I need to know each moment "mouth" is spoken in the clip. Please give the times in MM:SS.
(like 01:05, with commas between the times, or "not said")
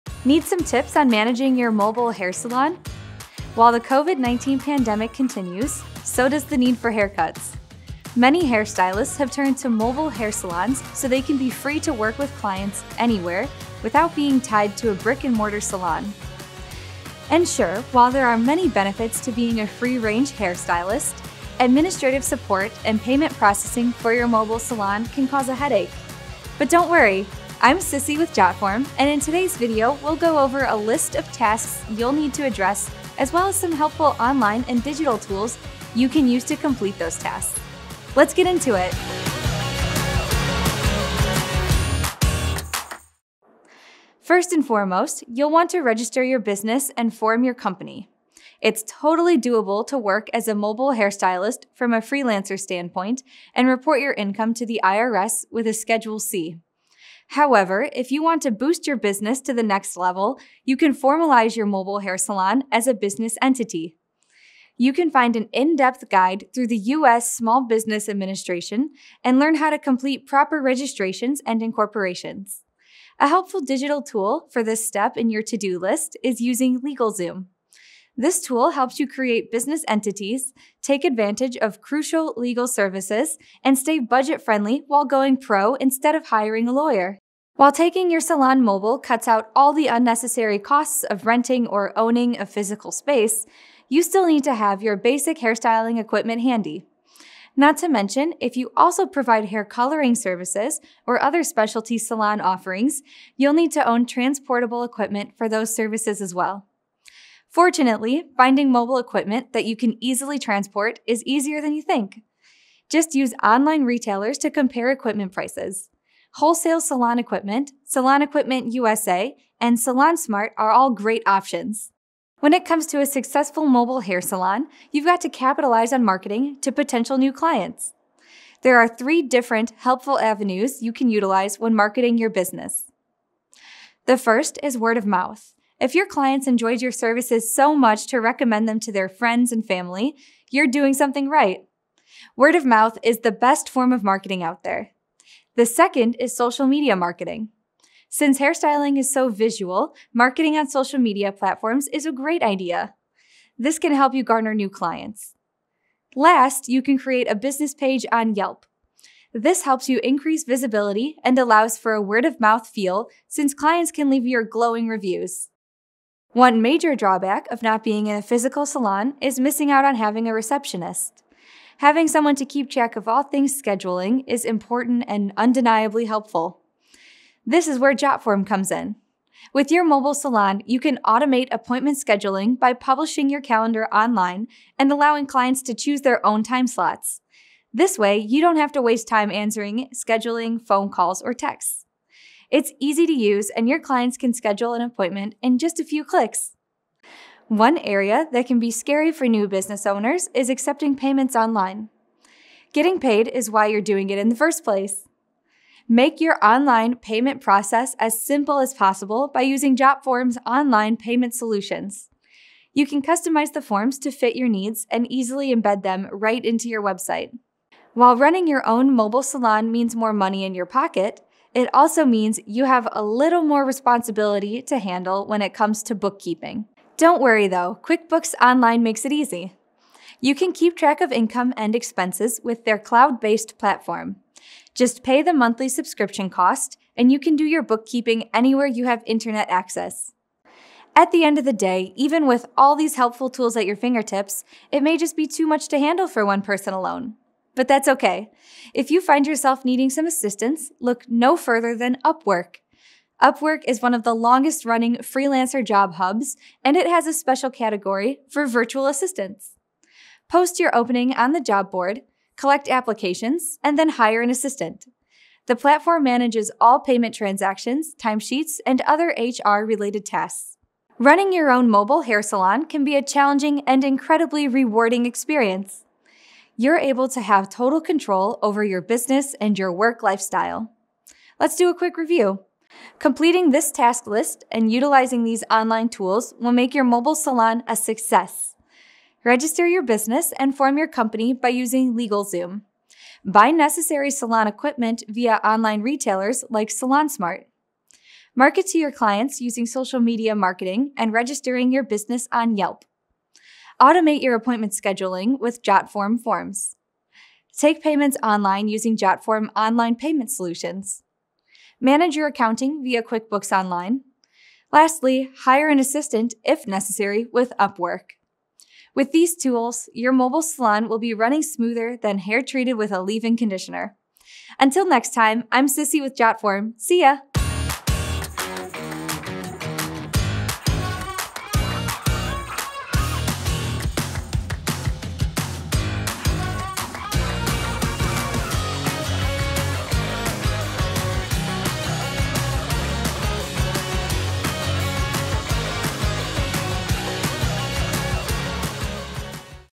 02:15, 02:22, 02:42.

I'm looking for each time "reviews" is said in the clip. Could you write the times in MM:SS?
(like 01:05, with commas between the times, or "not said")
02:44, 04:41.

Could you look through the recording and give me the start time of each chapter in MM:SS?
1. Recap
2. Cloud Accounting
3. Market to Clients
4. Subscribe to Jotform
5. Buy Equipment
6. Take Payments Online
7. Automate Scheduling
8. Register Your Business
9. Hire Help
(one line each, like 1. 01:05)
1. 04:43
2. 03:38
3. 02:02
4. 05:26
5. 01:28
6. 03:17
7. 02:46
8. 00:44
9. 04:00.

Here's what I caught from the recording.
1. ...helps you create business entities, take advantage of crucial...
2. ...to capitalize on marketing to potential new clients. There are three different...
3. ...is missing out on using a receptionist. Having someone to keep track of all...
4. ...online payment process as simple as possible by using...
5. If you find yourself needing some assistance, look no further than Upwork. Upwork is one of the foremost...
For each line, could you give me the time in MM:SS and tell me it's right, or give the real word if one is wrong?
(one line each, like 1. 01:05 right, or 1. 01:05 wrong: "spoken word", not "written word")
1. 01:18 right
2. 02:05 right
3. 02:49 wrong: "having", not "using"
4. 03:26 right
5. 04:08 wrong: "longest", not "foremost".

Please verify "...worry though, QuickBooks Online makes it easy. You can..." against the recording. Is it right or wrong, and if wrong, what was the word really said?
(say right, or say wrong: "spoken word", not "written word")
right.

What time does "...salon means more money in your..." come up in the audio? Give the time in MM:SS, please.
03:39.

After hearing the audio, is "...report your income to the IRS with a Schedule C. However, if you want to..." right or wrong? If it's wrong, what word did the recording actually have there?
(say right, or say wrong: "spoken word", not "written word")
right.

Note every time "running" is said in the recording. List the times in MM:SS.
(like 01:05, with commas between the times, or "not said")
03:38, 04:14, 04:30, 05:21.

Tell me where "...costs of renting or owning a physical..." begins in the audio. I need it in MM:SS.
01:30.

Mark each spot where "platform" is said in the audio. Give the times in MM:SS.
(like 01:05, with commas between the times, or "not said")
02:31, 03:53, 04:25.